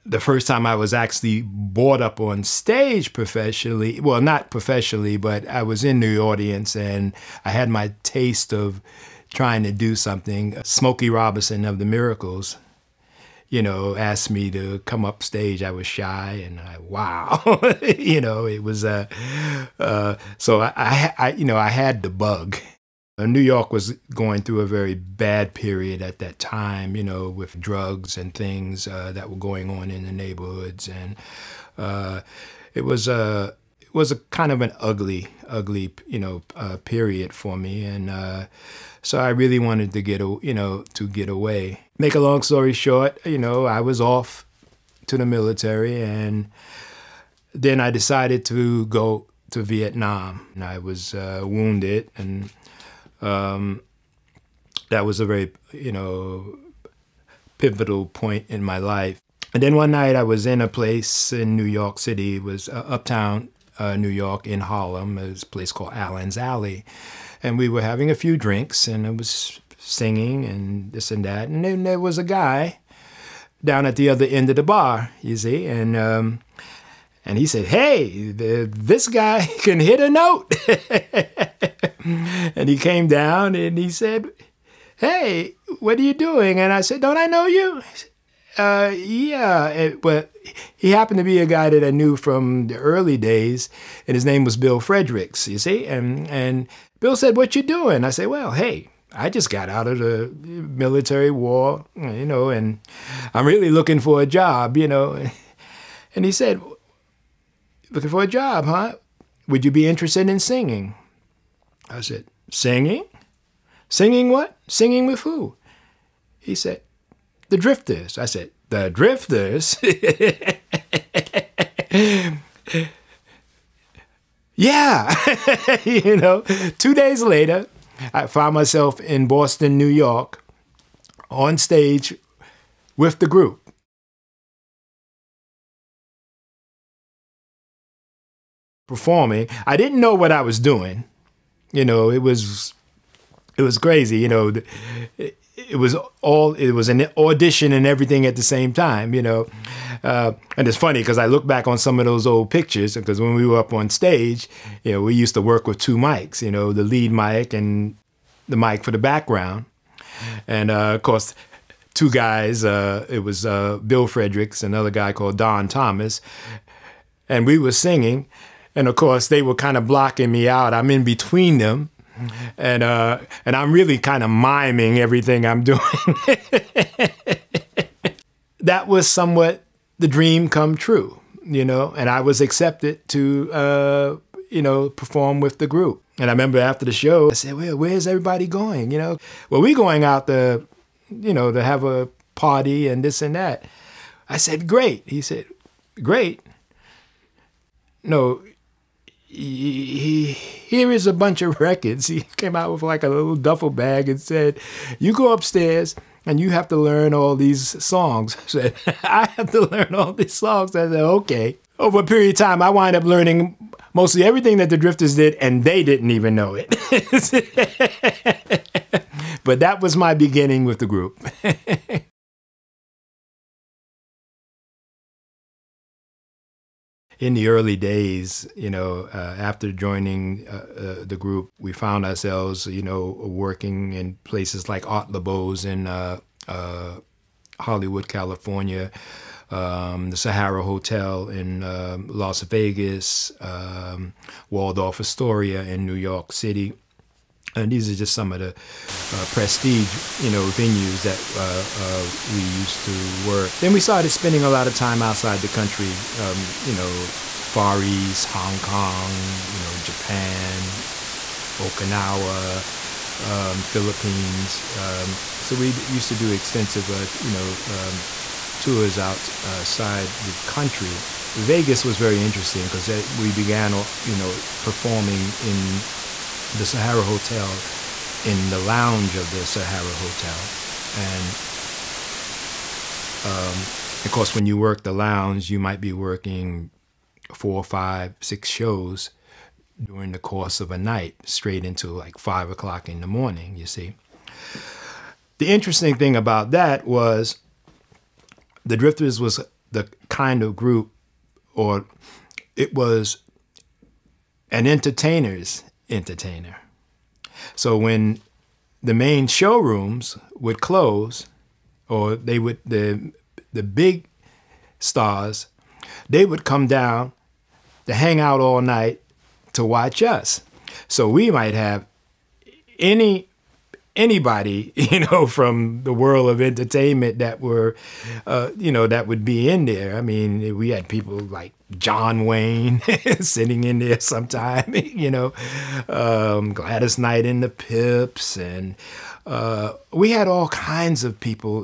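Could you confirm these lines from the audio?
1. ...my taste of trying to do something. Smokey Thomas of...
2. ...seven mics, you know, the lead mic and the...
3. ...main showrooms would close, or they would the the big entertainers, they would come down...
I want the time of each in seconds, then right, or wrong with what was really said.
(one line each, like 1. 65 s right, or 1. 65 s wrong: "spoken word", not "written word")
1. 7 s wrong: "Robinson", not "Thomas"
2. 155 s wrong: "two", not "seven"
3. 308 s wrong: "stars", not "entertainers".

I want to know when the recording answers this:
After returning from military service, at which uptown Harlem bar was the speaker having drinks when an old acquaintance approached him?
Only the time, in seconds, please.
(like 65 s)
65 s.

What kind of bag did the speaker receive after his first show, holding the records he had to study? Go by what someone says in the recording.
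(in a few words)
Duffel bag.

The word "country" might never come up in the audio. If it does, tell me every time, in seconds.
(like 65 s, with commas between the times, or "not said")
255 s, 270 s.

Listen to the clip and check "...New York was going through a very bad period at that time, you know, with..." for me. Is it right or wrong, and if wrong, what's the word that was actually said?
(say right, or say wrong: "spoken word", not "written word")
right.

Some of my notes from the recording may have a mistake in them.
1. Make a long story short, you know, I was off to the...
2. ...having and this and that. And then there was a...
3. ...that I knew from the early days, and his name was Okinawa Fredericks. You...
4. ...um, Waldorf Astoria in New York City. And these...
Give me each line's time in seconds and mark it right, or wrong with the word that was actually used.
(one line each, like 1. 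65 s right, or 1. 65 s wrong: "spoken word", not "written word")
1. 41 s right
2. 69 s wrong: "singing", not "having"
3. 91 s wrong: "Bill", not "Okinawa"
4. 243 s right.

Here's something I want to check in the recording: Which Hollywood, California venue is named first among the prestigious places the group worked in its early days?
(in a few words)
Art LeBeau's.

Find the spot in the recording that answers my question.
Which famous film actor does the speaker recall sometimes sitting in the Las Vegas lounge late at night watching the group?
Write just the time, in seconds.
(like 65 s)
331 s.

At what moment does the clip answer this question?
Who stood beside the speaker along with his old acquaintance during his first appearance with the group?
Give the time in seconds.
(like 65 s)
165 s.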